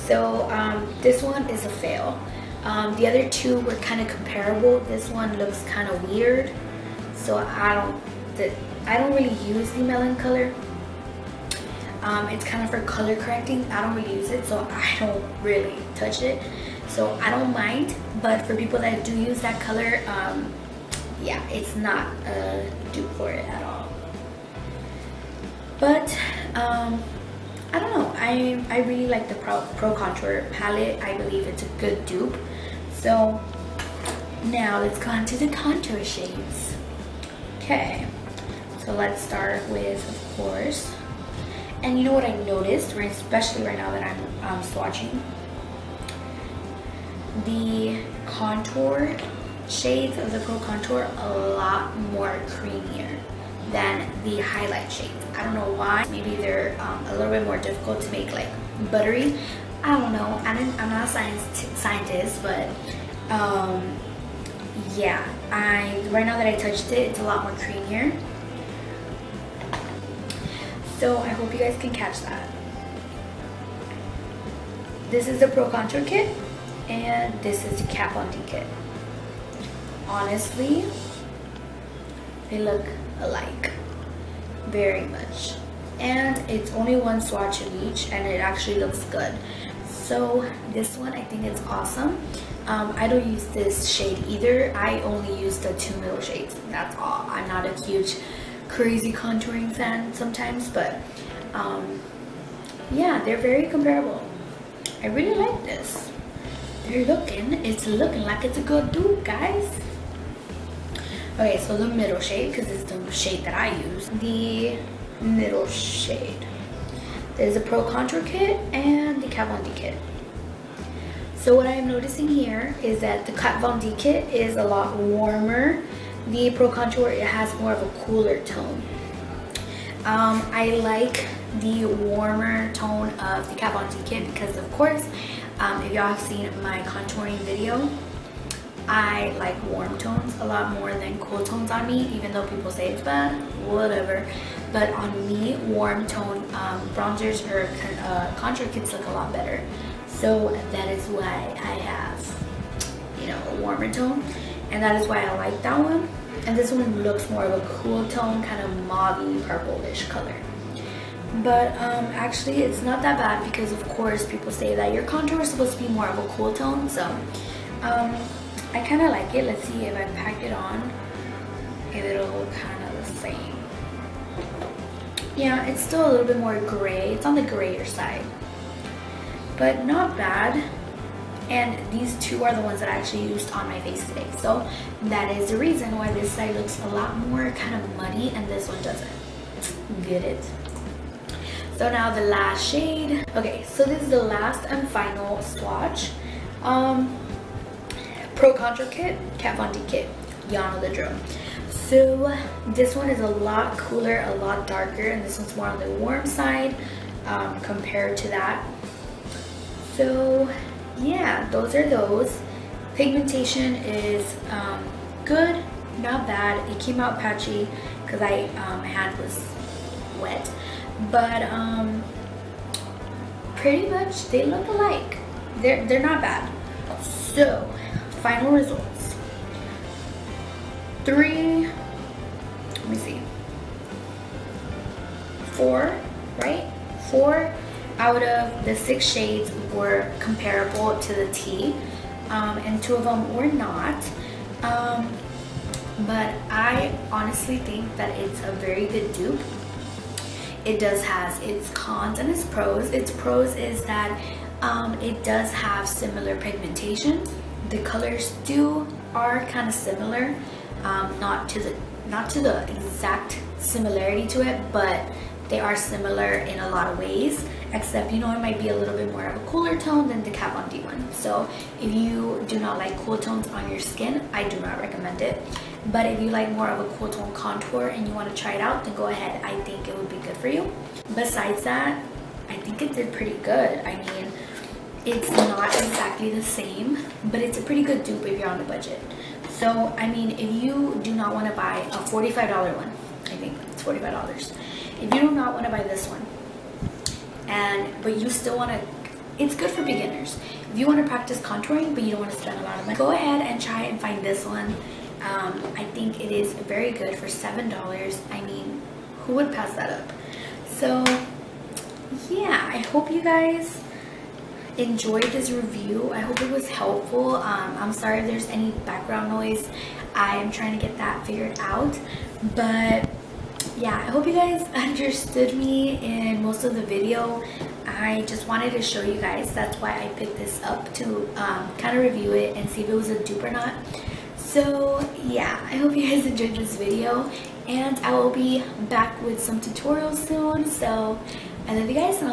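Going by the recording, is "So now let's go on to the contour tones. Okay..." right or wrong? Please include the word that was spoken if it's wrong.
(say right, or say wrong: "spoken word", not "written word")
wrong: "shades", not "tones".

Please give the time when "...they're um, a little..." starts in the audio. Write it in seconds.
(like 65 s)
56 s.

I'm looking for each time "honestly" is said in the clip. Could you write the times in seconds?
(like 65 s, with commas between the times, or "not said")
80 s, 247 s.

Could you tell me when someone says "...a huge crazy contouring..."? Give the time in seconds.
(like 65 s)
97 s.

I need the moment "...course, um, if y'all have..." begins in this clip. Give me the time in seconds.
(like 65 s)
134 s.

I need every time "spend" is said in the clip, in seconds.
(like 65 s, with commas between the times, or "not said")
302 s.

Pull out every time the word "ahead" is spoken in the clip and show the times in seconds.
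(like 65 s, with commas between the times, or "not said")
279 s, 303 s.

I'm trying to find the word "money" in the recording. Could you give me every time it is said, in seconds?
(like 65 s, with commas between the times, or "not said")
302 s.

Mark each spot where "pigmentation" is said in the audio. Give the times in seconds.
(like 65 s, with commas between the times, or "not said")
212 s, 256 s.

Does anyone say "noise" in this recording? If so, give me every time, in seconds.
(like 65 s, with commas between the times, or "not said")
319 s.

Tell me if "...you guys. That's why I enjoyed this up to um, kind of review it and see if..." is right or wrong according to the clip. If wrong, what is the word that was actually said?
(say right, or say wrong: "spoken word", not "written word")
wrong: "picked", not "enjoyed".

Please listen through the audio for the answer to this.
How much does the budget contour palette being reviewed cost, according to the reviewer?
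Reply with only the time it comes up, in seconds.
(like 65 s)
307 s.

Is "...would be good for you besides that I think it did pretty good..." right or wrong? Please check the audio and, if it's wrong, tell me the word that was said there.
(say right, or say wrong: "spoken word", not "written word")
right.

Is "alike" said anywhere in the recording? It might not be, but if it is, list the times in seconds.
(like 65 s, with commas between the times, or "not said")
83 s, 224 s.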